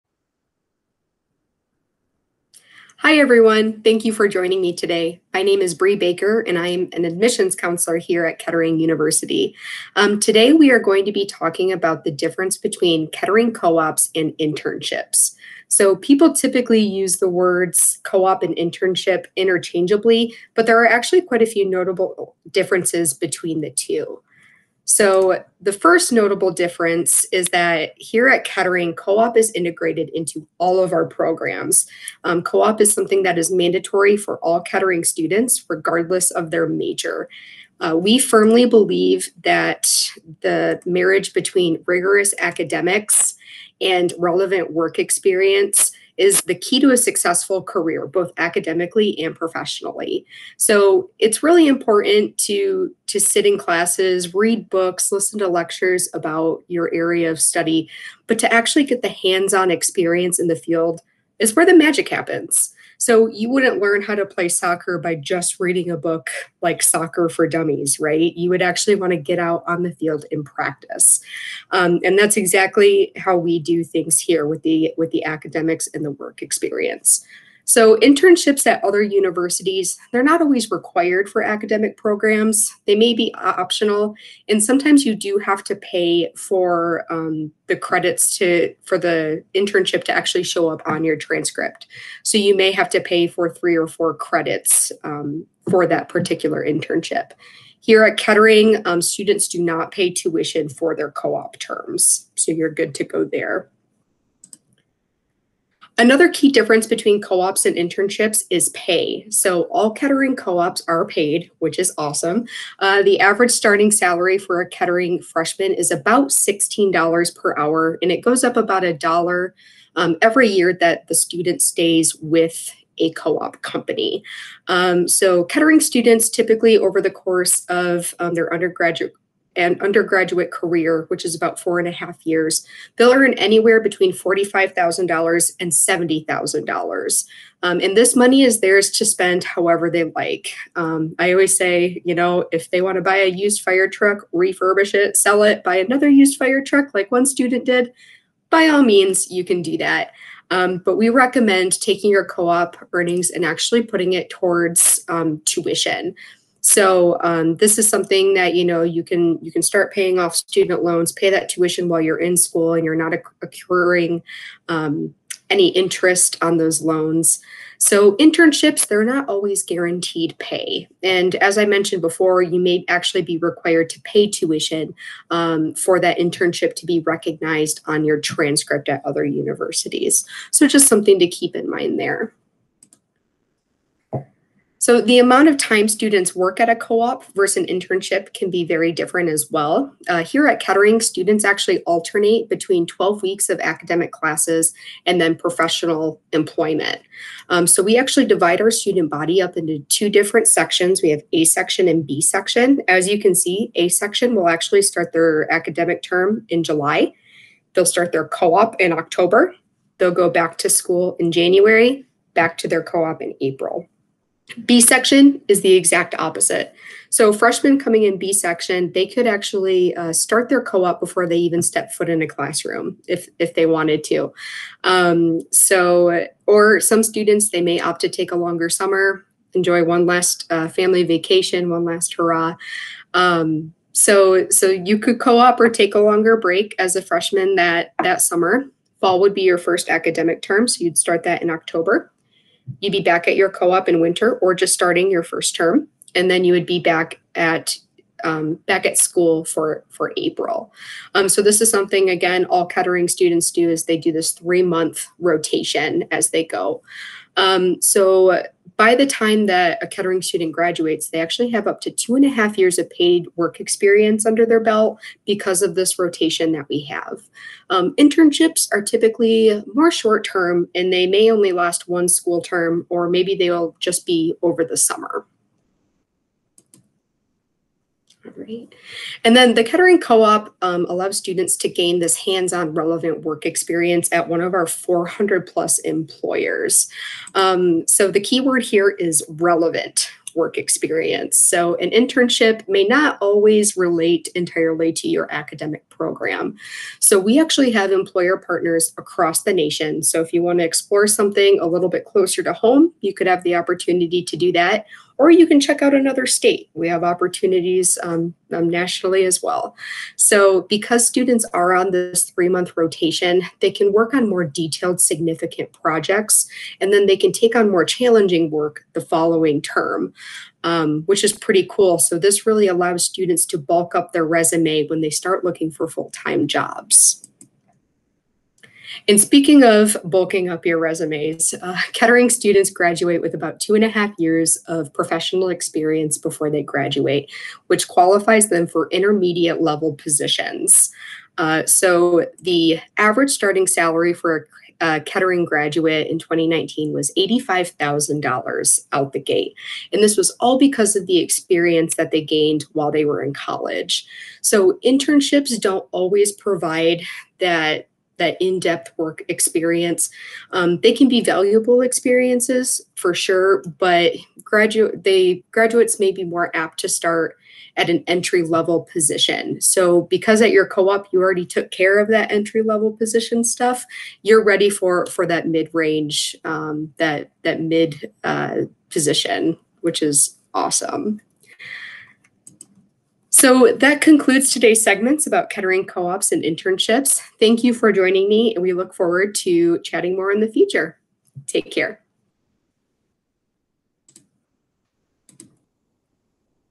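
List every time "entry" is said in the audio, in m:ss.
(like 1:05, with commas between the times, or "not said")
6:08, 6:12.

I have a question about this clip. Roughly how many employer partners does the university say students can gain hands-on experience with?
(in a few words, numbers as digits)
400.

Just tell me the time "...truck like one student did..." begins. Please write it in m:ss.
2:26.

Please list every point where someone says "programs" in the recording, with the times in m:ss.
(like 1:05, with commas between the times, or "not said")
0:31, 1:21, 4:56.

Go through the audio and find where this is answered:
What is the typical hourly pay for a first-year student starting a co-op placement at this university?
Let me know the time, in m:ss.
1:56.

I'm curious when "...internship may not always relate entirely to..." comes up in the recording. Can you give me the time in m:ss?
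4:51.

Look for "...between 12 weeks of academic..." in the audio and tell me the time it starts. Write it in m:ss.
3:12.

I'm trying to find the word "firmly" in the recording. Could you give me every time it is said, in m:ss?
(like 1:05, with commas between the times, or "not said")
0:38.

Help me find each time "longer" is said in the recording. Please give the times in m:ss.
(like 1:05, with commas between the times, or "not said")
3:48, 3:55.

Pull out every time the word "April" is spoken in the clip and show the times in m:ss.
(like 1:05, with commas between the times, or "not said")
3:33, 4:10.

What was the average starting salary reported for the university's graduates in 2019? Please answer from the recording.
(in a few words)
$85,000.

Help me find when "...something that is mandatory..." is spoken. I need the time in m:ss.
0:32.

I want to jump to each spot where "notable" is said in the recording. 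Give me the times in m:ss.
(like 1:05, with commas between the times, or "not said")
0:21, 0:26.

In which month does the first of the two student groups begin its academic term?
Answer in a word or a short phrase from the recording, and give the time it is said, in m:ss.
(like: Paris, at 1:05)
July, at 3:26.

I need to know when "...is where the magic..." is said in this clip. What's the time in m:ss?
1:01.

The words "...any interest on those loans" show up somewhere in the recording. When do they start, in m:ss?
2:45.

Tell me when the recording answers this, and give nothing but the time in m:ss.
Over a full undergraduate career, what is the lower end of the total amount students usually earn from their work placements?
2:14.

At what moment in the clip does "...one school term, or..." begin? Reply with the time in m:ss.
4:31.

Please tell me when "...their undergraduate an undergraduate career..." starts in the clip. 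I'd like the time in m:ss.
2:08.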